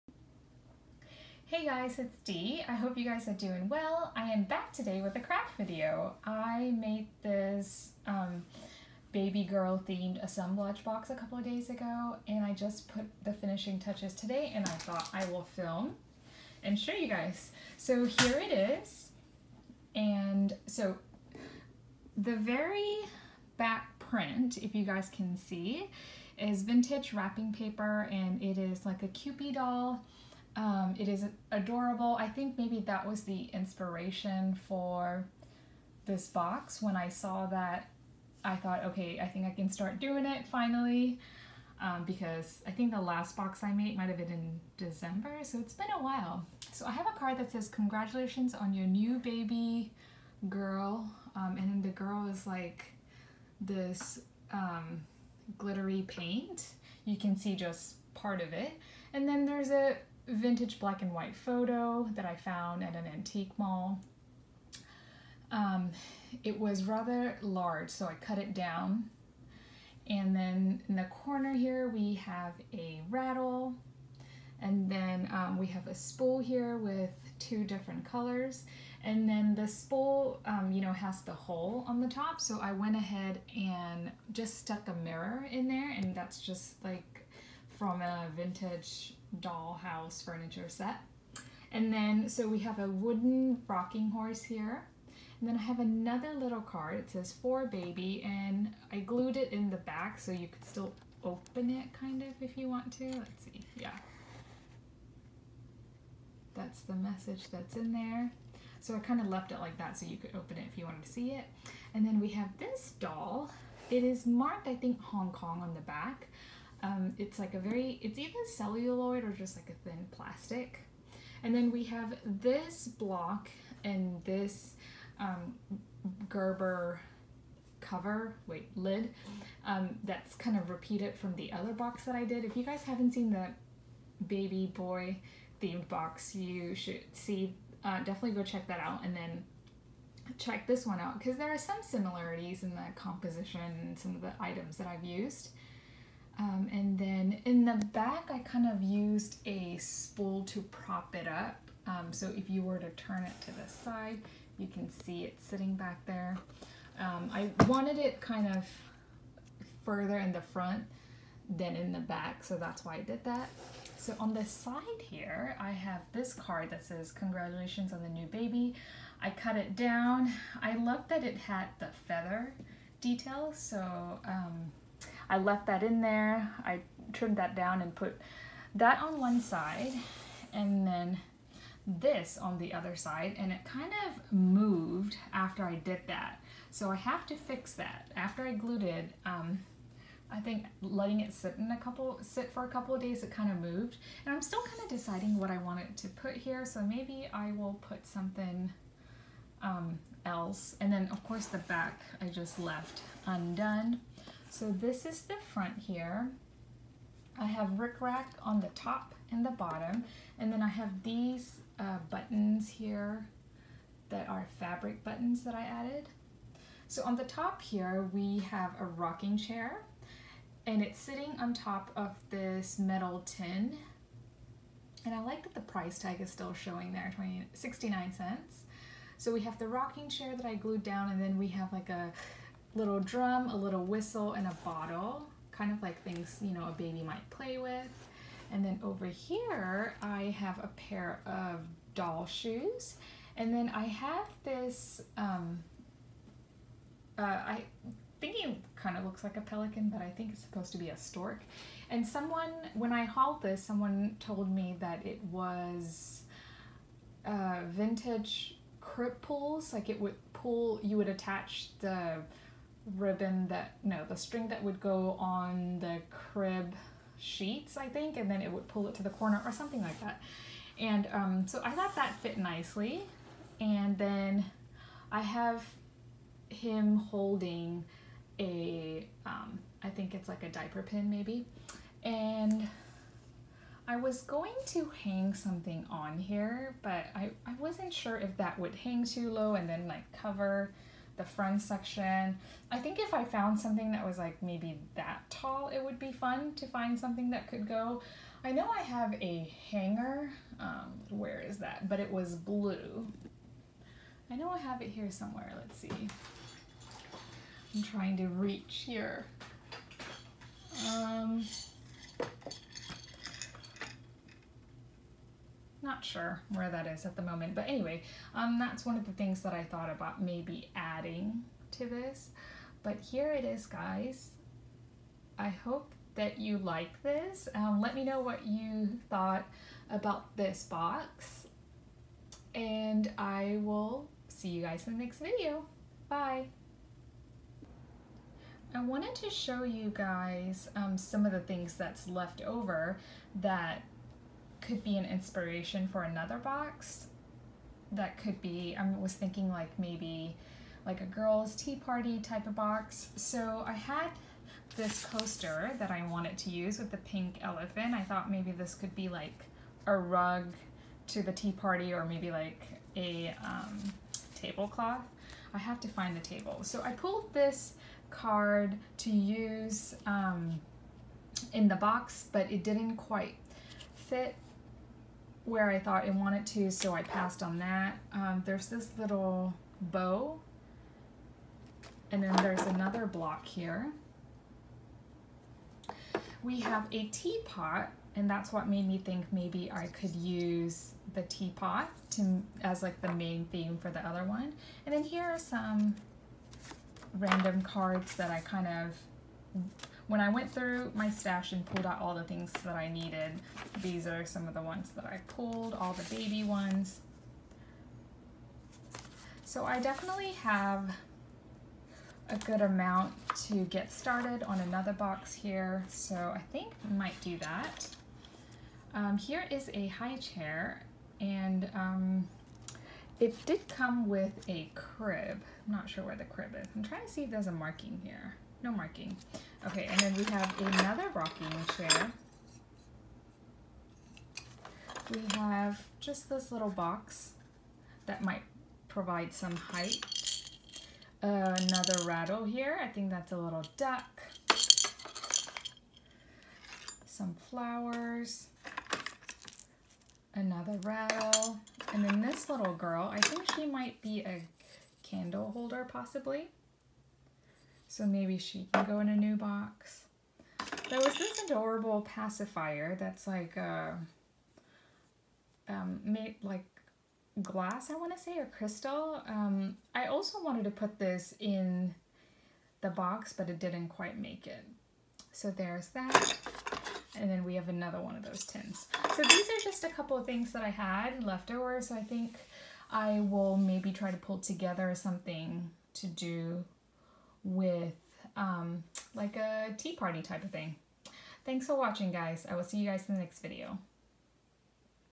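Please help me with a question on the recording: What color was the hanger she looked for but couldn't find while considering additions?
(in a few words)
Blue.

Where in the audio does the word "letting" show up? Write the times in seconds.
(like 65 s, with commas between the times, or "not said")
190 s.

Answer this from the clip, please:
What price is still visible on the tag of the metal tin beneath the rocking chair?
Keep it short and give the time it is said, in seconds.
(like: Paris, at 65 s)
69 cents, at 227 s.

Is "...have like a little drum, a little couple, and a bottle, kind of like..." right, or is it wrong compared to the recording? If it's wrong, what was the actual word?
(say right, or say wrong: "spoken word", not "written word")
wrong: "whistle", not "couple".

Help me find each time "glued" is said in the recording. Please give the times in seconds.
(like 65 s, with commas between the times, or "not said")
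98 s, 188 s, 230 s.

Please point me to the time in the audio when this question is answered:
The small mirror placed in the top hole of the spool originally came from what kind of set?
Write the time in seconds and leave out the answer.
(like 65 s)
88 s.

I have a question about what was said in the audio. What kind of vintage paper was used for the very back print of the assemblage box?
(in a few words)
Wrapping paper.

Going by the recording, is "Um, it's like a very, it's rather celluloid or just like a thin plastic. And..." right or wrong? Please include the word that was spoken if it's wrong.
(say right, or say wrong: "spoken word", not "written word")
wrong: "either", not "rather".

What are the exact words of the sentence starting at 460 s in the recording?
There was this adorable pacifier that's like uh, um, made like glass, I want to say, or crystal.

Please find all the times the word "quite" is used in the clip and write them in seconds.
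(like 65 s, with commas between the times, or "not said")
372 s, 473 s.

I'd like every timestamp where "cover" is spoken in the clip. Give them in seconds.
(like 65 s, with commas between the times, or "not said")
127 s, 290 s.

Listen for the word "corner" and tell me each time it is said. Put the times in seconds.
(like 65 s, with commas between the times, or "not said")
71 s, 269 s.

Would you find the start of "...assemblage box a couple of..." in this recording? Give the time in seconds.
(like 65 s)
10 s.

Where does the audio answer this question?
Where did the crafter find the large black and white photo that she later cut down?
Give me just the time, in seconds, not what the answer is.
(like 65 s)
63 s.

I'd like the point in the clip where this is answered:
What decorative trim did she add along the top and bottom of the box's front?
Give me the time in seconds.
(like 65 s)
207 s.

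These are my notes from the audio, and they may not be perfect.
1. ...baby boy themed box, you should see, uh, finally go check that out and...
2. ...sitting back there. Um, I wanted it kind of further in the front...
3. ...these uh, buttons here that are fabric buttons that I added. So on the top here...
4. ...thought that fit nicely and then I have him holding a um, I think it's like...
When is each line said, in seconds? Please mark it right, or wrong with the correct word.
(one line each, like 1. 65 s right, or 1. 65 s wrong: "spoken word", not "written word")
1. 134 s wrong: "definitely", not "finally"
2. 155 s right
3. 211 s right
4. 271 s right.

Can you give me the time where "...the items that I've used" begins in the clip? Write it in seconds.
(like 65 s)
144 s.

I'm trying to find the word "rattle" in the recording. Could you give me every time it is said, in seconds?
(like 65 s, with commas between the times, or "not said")
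73 s, 442 s, 450 s.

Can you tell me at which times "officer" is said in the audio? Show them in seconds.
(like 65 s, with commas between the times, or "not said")
not said.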